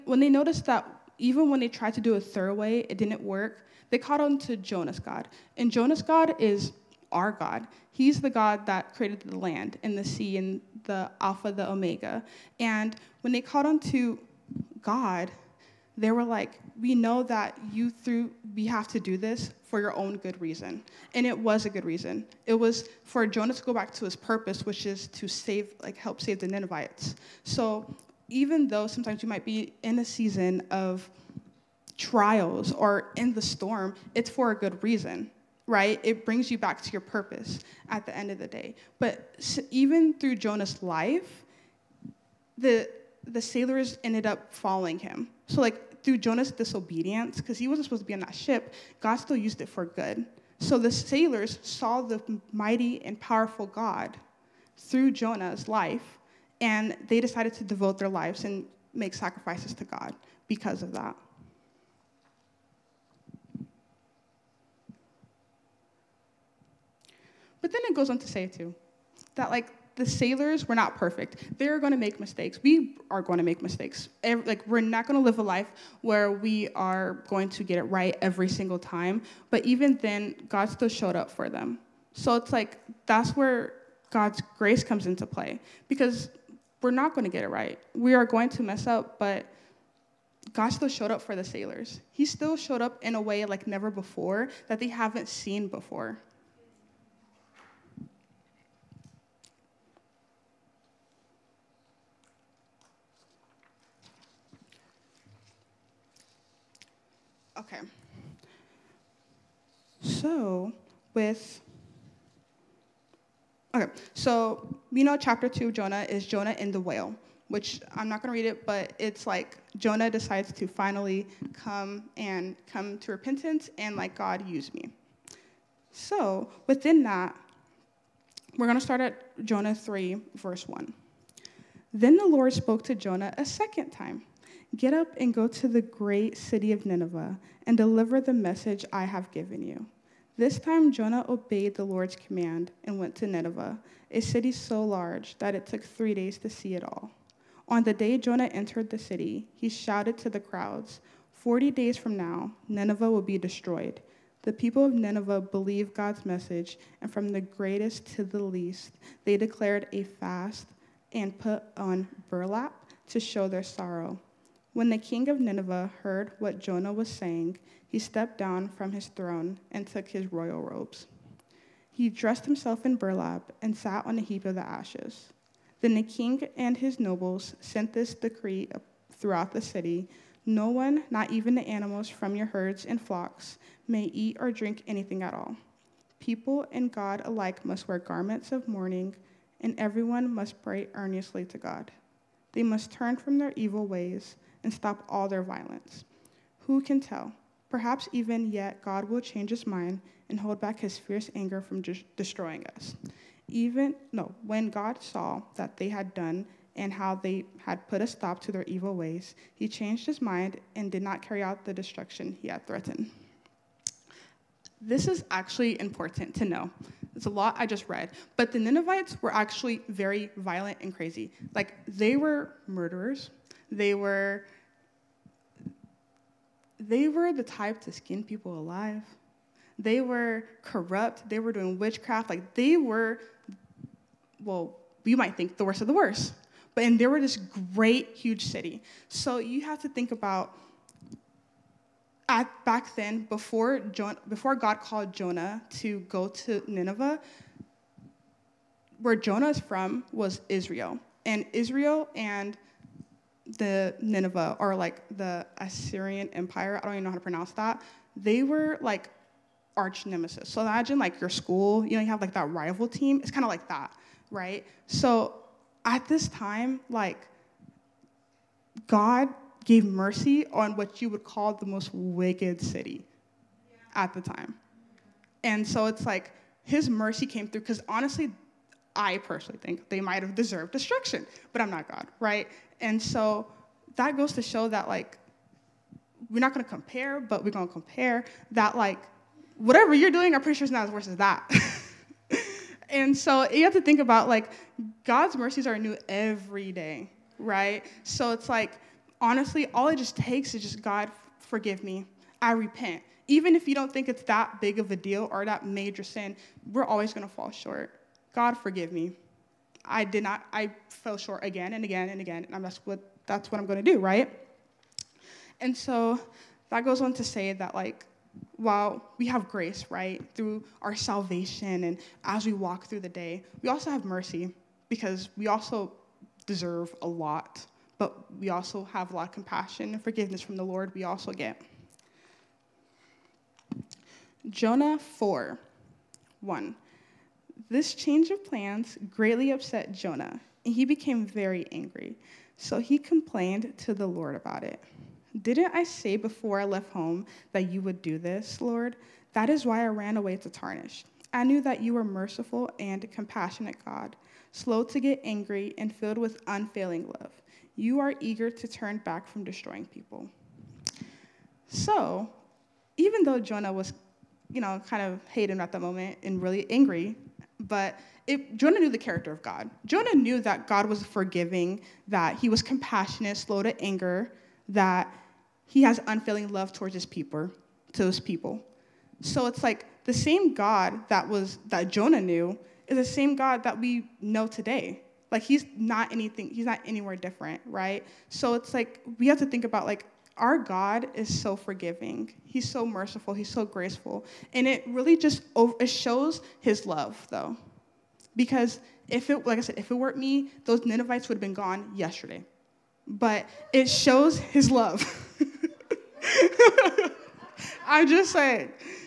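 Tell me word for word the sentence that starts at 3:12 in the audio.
They must turn from their evil ways and stop all their violence.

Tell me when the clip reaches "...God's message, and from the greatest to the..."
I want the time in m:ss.
2:35.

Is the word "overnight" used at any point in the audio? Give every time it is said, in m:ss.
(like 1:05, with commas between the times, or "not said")
not said.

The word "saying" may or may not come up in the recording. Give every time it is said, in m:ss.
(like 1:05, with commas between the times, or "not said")
2:47, 6:48.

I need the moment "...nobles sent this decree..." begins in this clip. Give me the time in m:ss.
2:56.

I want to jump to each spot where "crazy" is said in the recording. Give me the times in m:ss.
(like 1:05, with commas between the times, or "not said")
3:40.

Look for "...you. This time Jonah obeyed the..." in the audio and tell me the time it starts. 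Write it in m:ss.
2:19.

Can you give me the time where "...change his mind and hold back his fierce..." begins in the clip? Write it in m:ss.
3:19.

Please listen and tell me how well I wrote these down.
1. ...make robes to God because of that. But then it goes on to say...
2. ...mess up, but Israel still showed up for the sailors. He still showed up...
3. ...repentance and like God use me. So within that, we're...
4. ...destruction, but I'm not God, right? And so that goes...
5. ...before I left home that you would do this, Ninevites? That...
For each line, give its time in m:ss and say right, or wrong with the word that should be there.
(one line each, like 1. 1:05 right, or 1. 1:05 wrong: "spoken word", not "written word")
1. 0:58 wrong: "sacrifices", not "robes"
2. 1:28 wrong: "God", not "Israel"
3. 2:03 right
4. 4:40 right
5. 5:46 wrong: "Lord", not "Ninevites".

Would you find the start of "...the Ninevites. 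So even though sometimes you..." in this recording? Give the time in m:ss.
0:26.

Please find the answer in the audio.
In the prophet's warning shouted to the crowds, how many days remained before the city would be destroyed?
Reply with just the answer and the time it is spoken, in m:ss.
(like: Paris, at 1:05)
40, at 2:31.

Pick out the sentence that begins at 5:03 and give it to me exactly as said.
Even if you don't think it's that big of a deal or that major sin, we're always going to fall short.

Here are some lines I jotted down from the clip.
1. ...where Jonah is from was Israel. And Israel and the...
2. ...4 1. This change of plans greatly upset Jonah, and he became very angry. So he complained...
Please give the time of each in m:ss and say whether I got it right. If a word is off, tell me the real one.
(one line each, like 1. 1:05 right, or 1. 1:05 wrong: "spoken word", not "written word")
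1. 4:08 right
2. 5:34 right.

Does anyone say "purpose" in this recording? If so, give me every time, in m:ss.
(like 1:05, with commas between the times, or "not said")
0:24, 0:36.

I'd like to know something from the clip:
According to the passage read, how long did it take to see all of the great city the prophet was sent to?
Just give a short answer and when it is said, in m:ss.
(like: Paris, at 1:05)
3 days, at 2:25.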